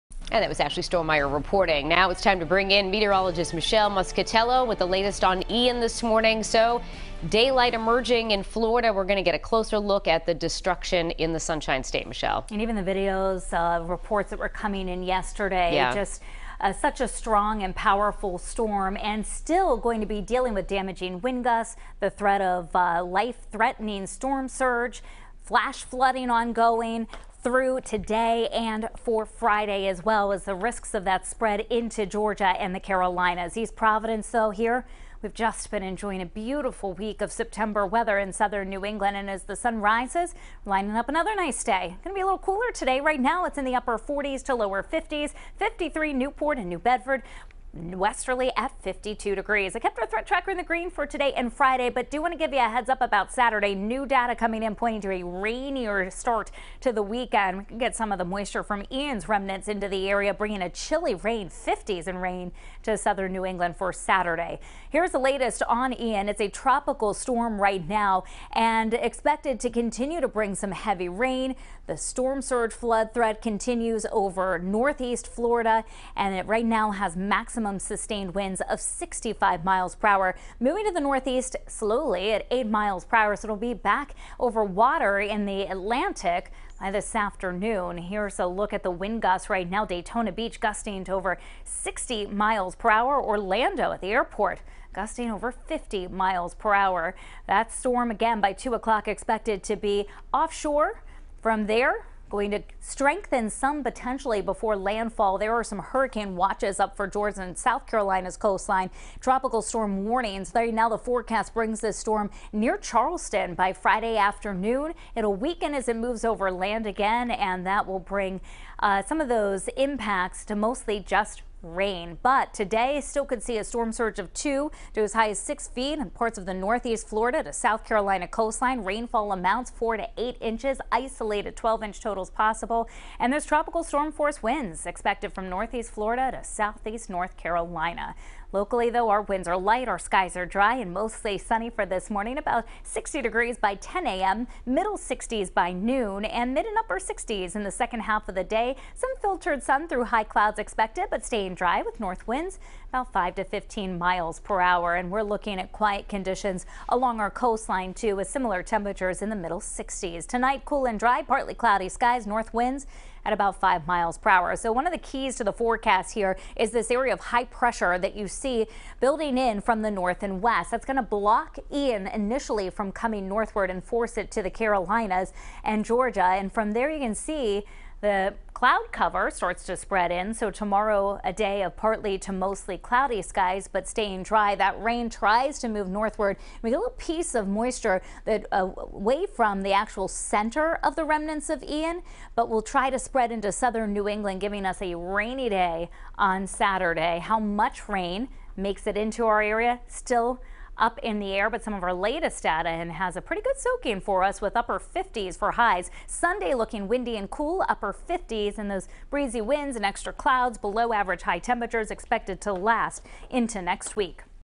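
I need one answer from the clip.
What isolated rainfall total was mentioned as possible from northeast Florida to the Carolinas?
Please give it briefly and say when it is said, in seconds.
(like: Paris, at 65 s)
12 inches, at 131 s.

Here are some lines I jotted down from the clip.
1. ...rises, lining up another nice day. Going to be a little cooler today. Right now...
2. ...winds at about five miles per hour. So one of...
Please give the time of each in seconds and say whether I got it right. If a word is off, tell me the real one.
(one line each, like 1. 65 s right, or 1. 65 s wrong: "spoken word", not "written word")
1. 39 s right
2. 162 s right.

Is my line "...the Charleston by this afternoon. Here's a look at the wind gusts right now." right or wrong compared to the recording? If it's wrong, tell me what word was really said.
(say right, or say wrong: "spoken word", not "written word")
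wrong: "Atlantic", not "Charleston".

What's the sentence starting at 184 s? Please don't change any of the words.
That rain tries to move northward.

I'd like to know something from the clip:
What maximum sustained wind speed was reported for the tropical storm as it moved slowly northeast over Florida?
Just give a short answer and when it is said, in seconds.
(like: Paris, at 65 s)
65 miles per hour, at 78 s.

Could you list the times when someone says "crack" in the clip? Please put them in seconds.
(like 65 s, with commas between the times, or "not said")
not said.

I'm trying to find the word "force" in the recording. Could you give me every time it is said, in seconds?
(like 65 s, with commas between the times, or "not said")
134 s, 173 s.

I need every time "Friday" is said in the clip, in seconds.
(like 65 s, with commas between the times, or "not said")
29 s, 51 s, 113 s.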